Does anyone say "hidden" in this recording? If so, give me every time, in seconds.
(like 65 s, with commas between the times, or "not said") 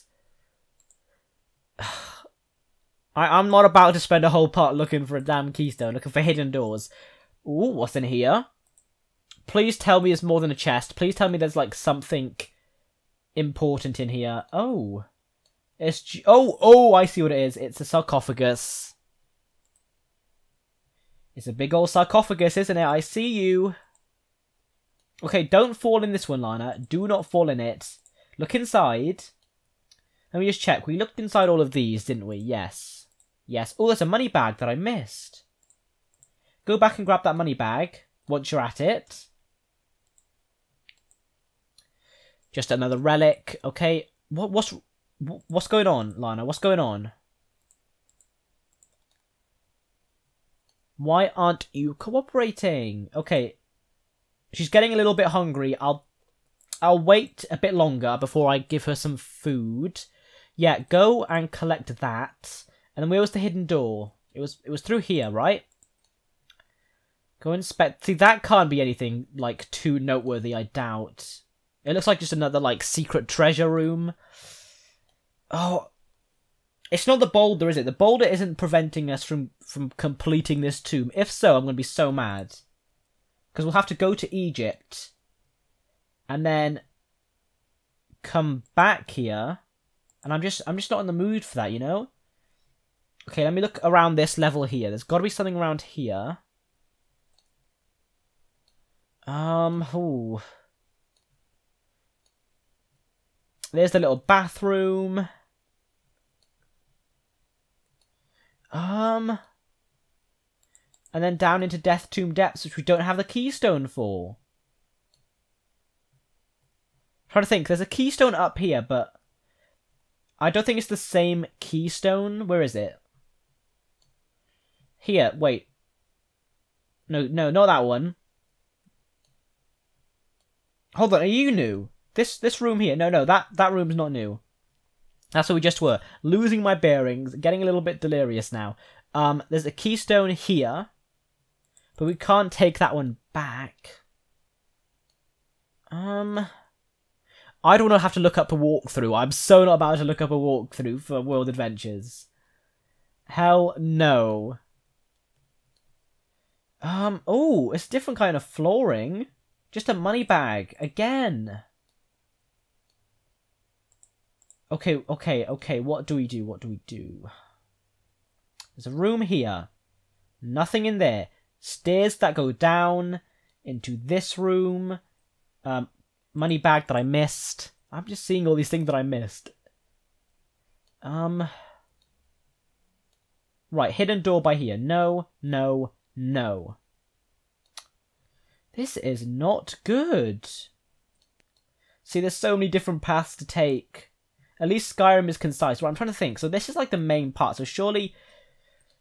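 6 s, 63 s, 183 s.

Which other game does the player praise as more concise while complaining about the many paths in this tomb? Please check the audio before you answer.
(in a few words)
Skyrim.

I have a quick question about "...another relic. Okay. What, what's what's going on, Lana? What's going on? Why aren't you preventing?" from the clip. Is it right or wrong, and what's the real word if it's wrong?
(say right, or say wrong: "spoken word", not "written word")
wrong: "cooperating", not "preventing".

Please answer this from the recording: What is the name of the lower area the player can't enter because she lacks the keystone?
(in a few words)
Death Tomb Depths.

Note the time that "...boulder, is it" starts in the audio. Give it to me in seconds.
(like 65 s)
77 s.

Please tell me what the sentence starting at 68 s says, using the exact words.
See, that can't be anything like too noteworthy, I doubt.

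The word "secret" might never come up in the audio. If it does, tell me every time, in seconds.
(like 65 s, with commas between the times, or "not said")
72 s.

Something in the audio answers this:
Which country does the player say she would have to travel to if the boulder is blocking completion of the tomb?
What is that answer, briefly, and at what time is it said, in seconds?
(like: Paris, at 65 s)
Egypt, at 84 s.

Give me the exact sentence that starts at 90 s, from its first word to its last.
And I'm just I'm just not in the mood for that, you know?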